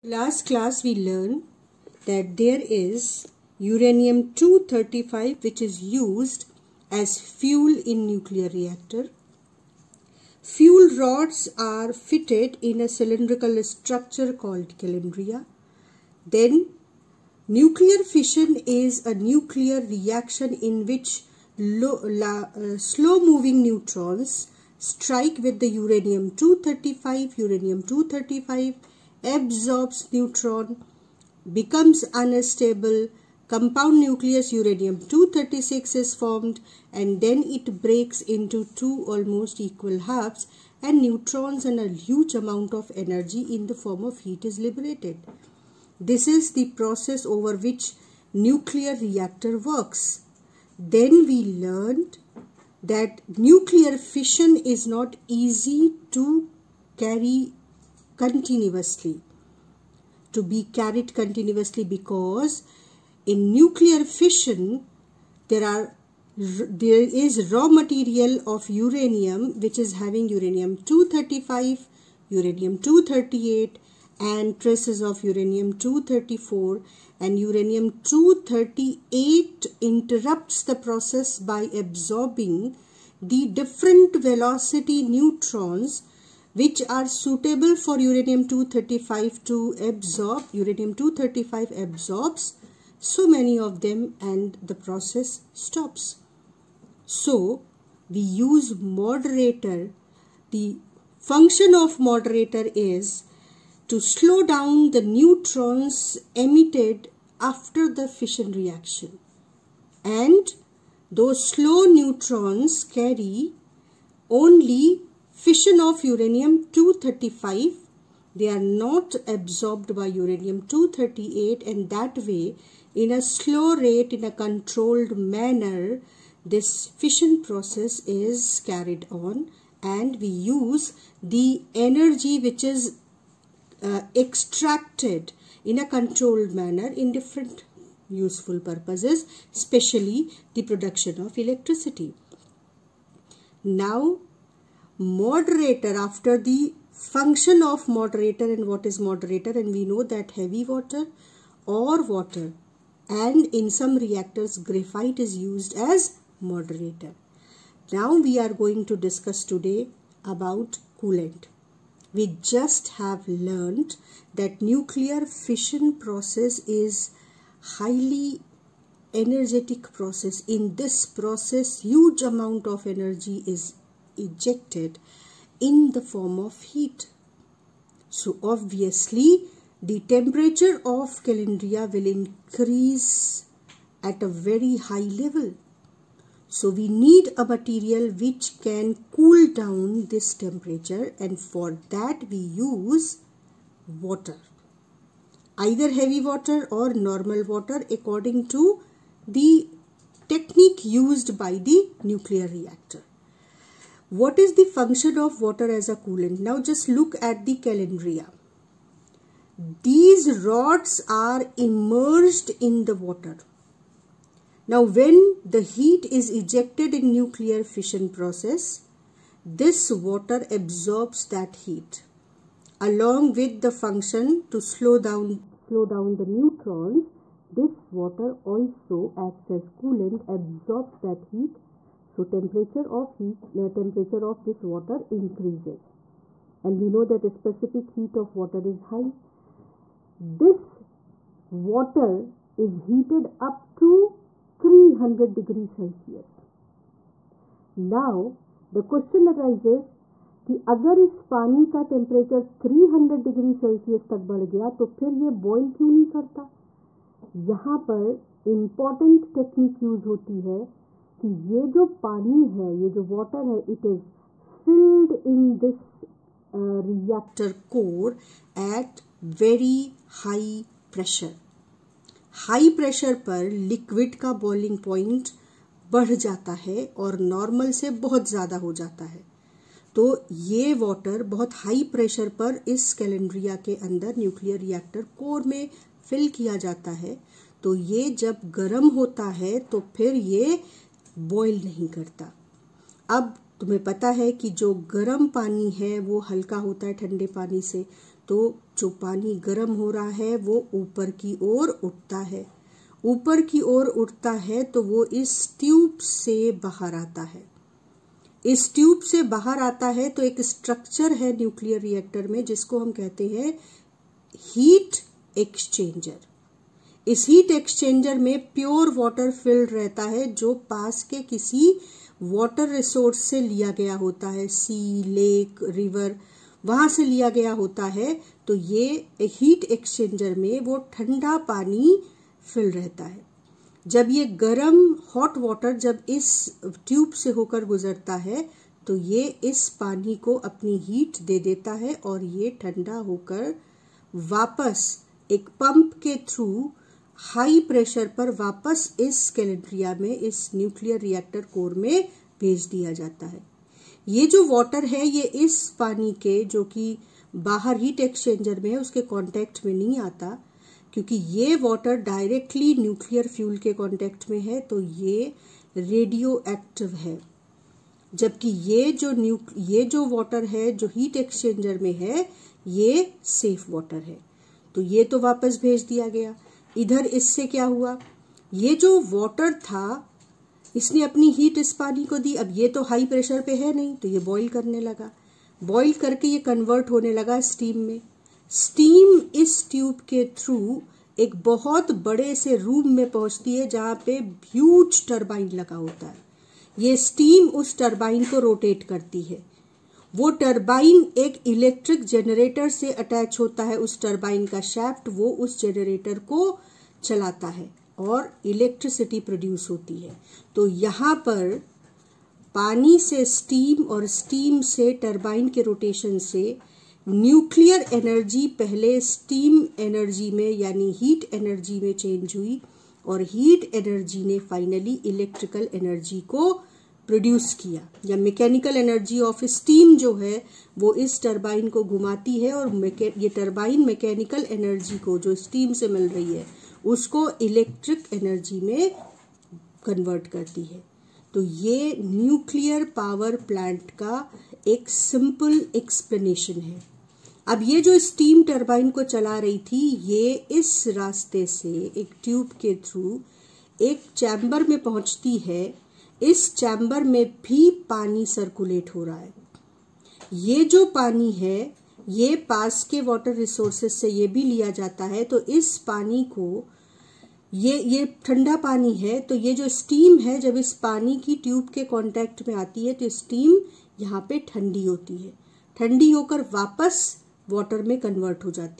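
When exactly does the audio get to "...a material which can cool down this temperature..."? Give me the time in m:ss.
3:07.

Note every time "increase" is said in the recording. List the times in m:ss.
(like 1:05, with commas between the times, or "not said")
3:02, 3:55.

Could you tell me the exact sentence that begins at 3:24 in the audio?
What is the function of water as a coolant?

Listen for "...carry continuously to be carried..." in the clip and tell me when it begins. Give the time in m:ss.
0:56.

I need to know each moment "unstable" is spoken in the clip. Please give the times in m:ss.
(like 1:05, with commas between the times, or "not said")
0:32.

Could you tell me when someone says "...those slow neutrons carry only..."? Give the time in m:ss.
1:51.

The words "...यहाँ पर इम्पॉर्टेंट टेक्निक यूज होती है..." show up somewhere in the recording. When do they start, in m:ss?
4:17.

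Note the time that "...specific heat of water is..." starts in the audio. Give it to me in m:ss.
3:57.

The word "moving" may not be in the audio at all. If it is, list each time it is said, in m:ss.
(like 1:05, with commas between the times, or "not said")
0:22.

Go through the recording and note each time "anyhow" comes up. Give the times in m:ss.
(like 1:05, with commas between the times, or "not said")
not said.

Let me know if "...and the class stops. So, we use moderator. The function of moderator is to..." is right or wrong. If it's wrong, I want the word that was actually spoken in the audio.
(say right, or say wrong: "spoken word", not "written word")
wrong: "process", not "class".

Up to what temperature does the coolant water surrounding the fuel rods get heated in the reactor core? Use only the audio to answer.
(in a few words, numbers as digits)
300 degrees Celsius.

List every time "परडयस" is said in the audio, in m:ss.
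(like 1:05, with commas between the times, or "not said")
6:49, 7:07.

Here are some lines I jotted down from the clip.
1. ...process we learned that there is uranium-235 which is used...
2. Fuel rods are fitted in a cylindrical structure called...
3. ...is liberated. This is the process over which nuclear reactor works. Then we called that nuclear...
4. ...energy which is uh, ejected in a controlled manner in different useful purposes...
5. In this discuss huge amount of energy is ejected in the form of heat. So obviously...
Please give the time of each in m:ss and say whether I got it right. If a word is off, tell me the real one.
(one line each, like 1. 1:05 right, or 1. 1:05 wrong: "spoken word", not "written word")
1. 0:00 wrong: "class", not "process"
2. 0:10 right
3. 0:44 wrong: "learned", not "called"
4. 2:11 wrong: "extracted", not "ejected"
5. 2:50 wrong: "process", not "discuss".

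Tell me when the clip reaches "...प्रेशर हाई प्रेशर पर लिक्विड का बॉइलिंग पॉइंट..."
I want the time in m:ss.
4:30.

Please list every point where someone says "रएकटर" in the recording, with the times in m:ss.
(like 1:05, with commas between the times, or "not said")
4:26, 4:44, 5:11, 5:51.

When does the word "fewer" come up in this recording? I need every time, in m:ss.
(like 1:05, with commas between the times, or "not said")
not said.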